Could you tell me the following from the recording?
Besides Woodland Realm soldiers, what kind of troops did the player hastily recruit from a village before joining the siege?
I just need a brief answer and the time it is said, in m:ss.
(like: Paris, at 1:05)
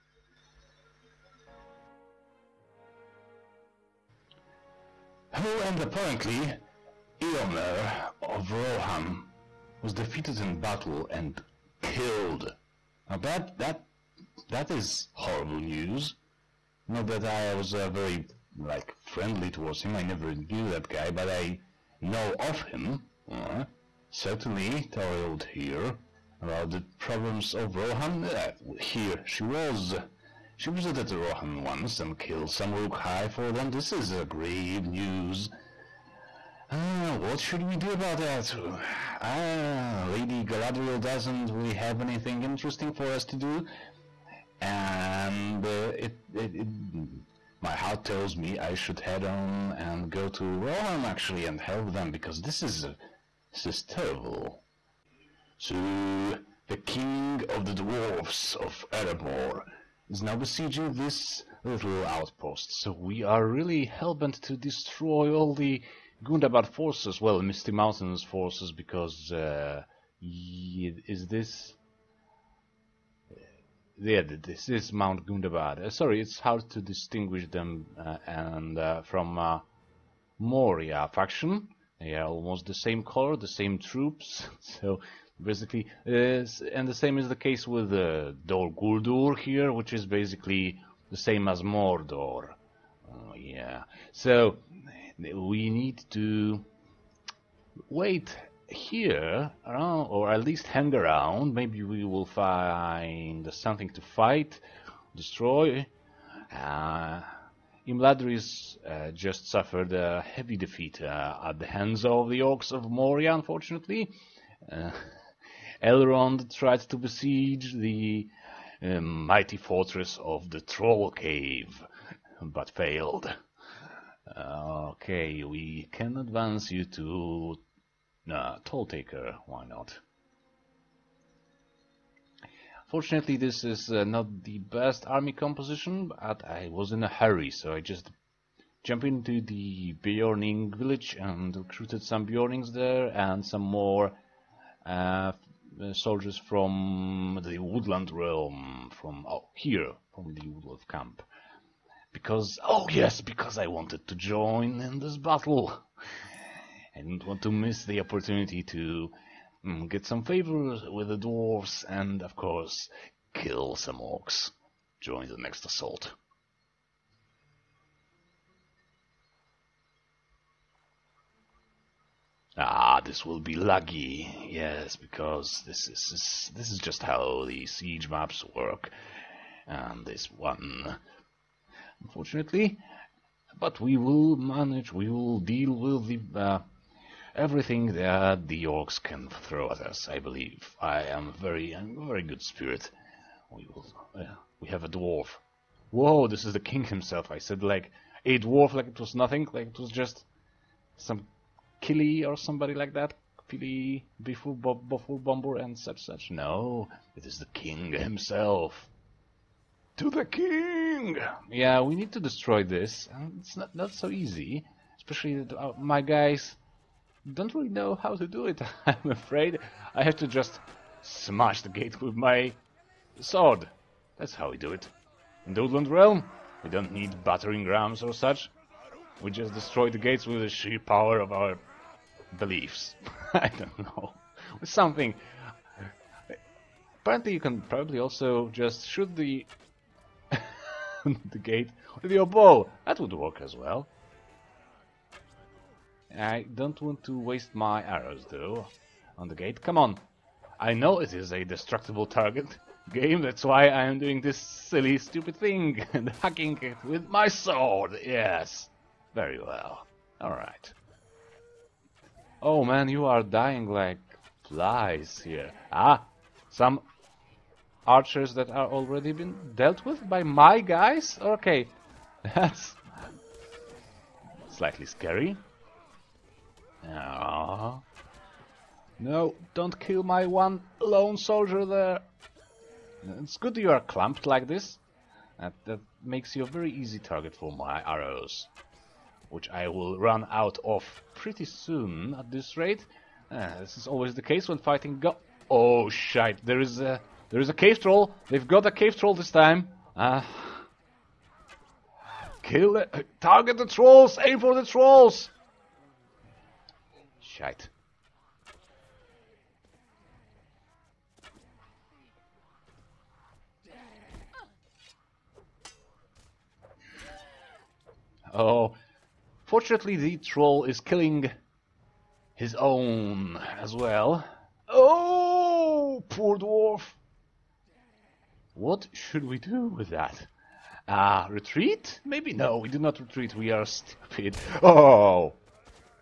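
Beornings, at 2:22.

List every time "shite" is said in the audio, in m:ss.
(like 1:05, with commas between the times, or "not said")
4:55, 5:07.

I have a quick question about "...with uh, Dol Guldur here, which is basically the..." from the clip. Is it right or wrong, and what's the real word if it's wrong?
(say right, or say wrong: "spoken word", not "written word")
right.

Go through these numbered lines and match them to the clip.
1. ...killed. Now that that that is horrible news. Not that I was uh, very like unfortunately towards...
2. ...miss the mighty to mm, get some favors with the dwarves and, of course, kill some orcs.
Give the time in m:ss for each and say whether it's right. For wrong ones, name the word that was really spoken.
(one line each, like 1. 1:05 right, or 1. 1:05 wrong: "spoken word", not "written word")
1. 0:11 wrong: "friendly", not "unfortunately"
2. 2:37 wrong: "opportunity", not "mighty".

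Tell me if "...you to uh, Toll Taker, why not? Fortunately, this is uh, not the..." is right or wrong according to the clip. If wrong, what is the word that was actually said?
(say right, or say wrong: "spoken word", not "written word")
right.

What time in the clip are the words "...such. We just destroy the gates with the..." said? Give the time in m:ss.
3:48.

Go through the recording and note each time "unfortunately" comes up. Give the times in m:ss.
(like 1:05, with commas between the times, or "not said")
1:53, 3:02.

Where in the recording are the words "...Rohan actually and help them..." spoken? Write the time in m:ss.
0:50.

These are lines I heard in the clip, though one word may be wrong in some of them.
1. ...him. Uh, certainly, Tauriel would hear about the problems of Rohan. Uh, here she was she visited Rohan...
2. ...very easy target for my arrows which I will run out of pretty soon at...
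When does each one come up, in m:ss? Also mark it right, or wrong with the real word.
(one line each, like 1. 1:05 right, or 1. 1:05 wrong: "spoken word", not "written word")
1. 0:22 right
2. 4:46 right.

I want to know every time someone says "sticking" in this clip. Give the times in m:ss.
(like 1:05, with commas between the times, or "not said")
not said.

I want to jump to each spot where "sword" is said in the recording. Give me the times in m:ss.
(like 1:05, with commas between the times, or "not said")
3:43, 4:17.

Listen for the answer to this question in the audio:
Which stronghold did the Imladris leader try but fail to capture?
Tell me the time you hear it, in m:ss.
2:00.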